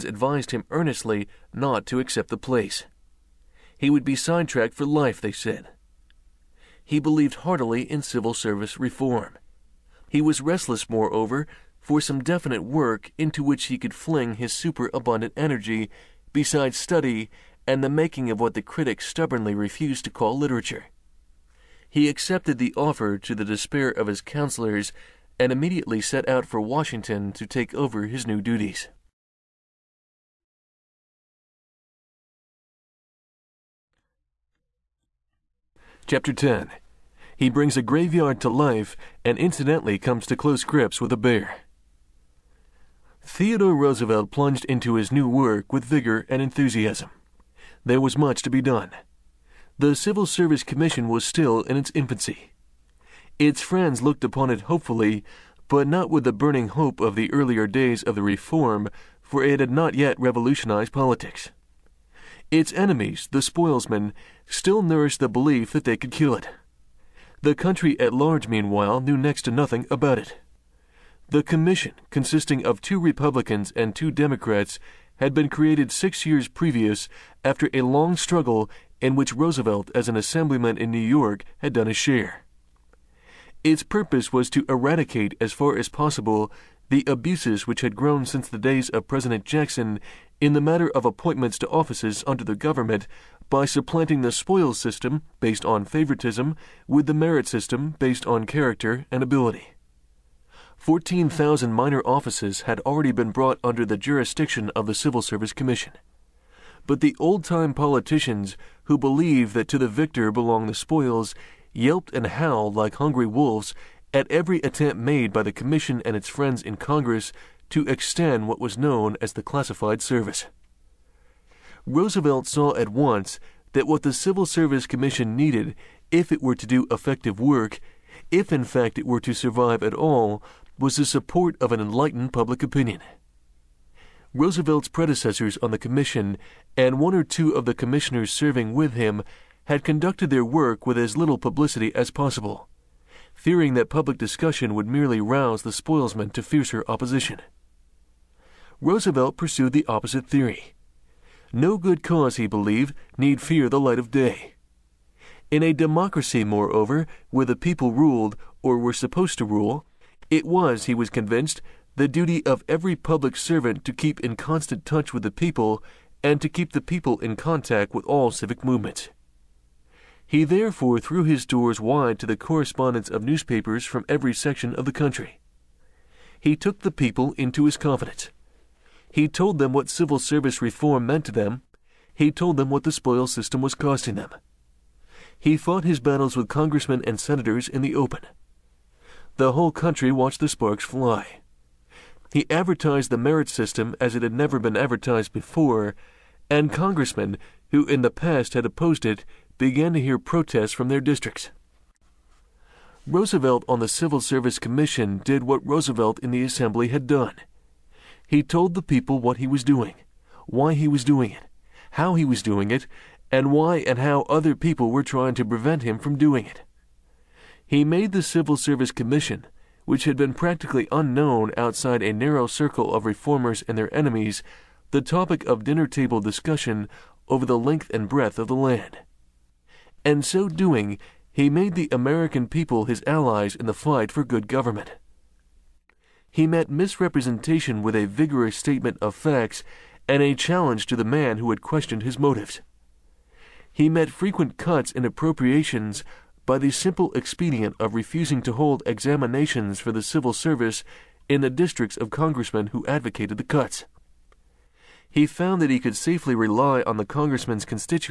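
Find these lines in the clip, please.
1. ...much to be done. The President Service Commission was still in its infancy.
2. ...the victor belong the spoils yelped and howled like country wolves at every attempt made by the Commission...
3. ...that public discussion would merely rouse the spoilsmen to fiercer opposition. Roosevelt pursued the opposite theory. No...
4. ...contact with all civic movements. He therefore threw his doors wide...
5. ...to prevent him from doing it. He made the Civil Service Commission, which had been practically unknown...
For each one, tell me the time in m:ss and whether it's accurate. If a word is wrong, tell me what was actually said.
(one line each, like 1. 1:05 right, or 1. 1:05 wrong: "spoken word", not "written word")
1. 0:48 wrong: "Civil", not "President"
2. 1:49 wrong: "hungry", not "country"
3. 2:23 right
4. 2:47 right
5. 3:35 right.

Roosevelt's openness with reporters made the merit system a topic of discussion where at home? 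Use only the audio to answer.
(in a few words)
Dinner table.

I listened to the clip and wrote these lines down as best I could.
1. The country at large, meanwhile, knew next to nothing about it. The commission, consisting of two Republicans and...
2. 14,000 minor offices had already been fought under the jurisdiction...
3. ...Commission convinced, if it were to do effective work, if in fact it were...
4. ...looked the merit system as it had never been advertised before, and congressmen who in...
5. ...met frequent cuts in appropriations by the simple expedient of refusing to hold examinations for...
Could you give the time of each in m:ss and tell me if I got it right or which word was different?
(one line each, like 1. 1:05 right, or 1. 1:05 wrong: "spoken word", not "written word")
1. 1:07 right
2. 1:40 wrong: "brought", not "fought"
3. 2:04 wrong: "needed", not "convinced"
4. 3:12 wrong: "advertised", not "looked"
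5. 4:03 right.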